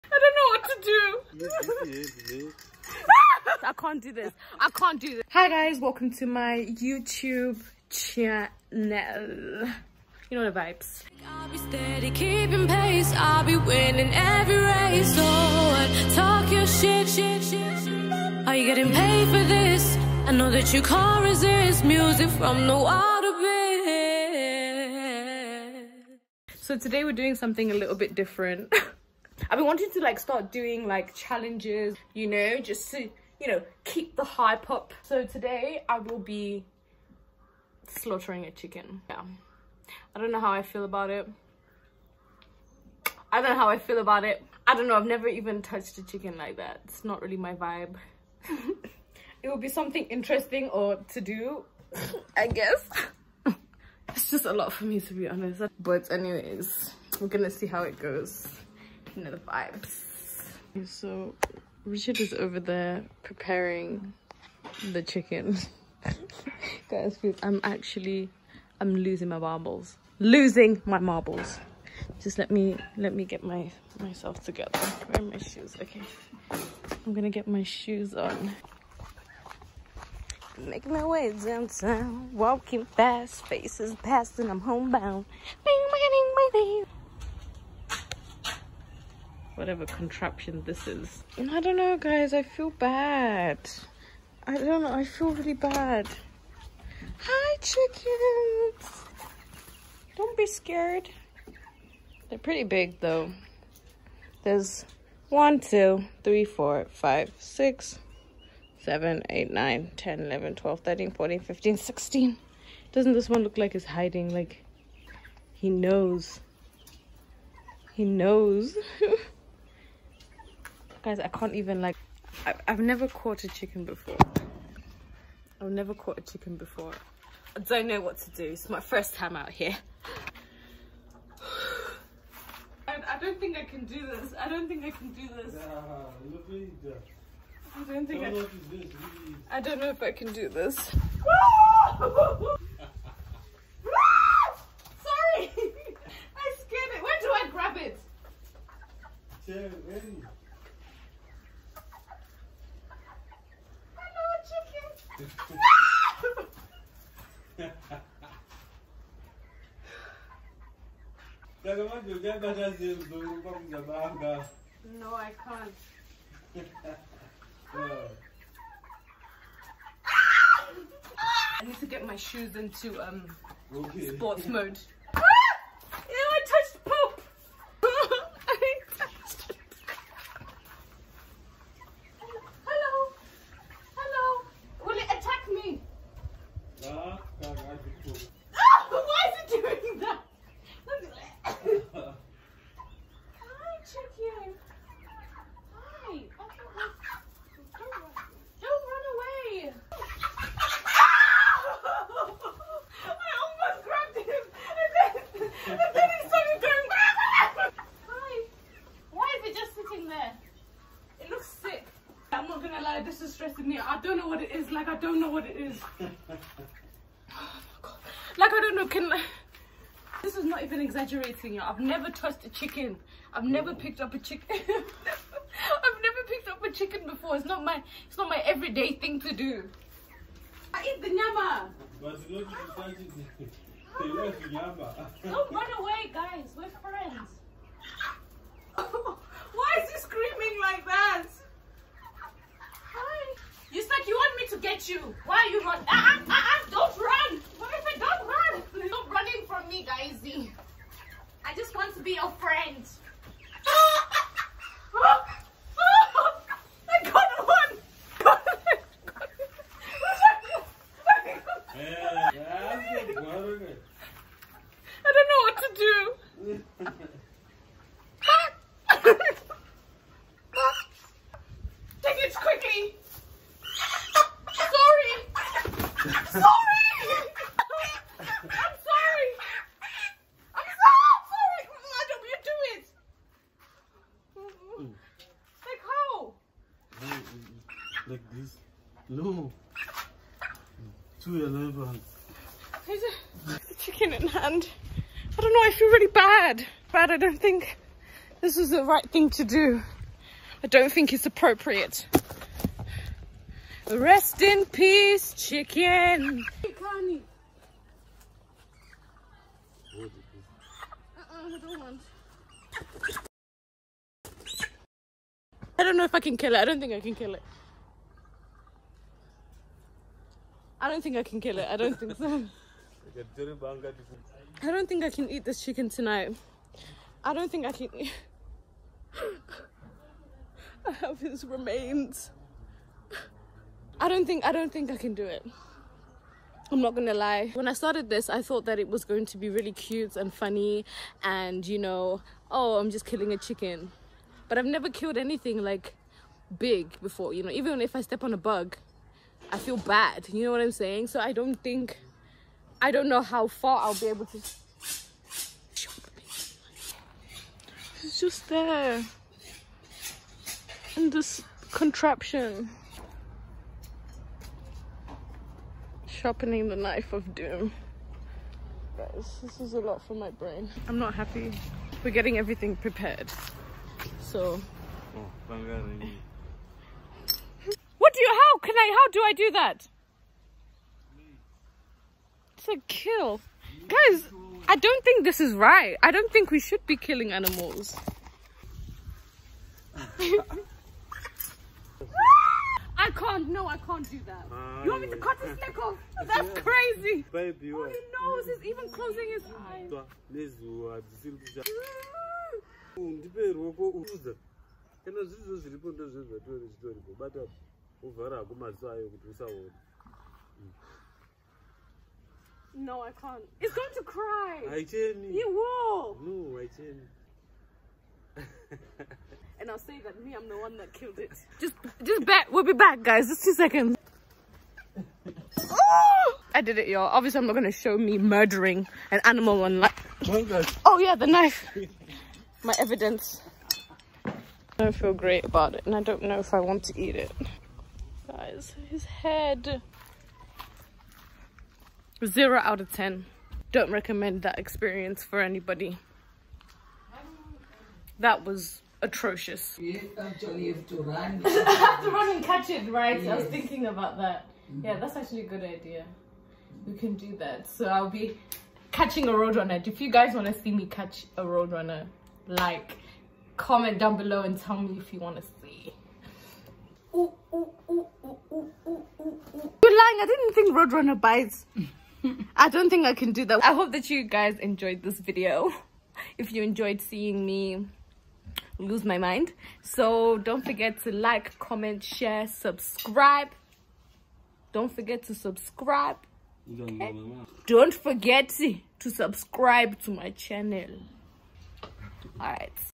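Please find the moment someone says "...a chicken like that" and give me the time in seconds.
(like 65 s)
45 s.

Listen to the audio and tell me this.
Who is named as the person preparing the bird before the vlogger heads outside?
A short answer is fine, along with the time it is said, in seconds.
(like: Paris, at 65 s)
Richard, at 61 s.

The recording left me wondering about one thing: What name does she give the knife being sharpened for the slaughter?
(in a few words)
Knife of doom.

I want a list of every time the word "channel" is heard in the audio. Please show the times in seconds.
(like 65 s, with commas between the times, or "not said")
7 s, 490 s.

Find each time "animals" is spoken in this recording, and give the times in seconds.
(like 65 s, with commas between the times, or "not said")
387 s, 429 s.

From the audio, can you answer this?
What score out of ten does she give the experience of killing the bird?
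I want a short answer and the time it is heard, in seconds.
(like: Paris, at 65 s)
0, at 442 s.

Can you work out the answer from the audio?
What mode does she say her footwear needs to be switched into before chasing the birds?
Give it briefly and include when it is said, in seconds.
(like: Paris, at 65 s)
Sports mode, at 174 s.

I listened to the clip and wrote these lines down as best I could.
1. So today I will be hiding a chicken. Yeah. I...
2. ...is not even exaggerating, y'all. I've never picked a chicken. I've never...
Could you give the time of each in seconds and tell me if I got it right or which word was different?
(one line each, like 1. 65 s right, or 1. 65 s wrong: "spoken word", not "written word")
1. 35 s wrong: "slaughtering", not "hiding"
2. 220 s wrong: "touched", not "picked".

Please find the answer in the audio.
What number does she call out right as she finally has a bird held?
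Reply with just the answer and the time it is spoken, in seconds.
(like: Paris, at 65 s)
211, at 291 s.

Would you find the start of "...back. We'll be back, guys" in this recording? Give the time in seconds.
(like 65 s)
422 s.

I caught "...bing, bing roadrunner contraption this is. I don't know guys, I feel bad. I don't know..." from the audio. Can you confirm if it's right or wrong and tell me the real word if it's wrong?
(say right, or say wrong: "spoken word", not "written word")
wrong: "whatever", not "roadrunner".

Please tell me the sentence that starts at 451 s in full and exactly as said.
I have to run and catch it, right?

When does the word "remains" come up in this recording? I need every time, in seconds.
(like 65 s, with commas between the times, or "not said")
331 s.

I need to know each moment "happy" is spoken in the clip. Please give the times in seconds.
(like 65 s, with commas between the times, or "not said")
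371 s.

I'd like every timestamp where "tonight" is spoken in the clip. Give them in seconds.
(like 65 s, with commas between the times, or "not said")
325 s.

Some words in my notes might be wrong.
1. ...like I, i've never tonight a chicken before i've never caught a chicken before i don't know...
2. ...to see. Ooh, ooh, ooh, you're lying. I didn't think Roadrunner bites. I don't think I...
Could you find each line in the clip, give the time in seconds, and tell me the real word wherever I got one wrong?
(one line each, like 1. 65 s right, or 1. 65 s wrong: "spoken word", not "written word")
1. 121 s wrong: "caught", not "tonight"
2. 465 s right.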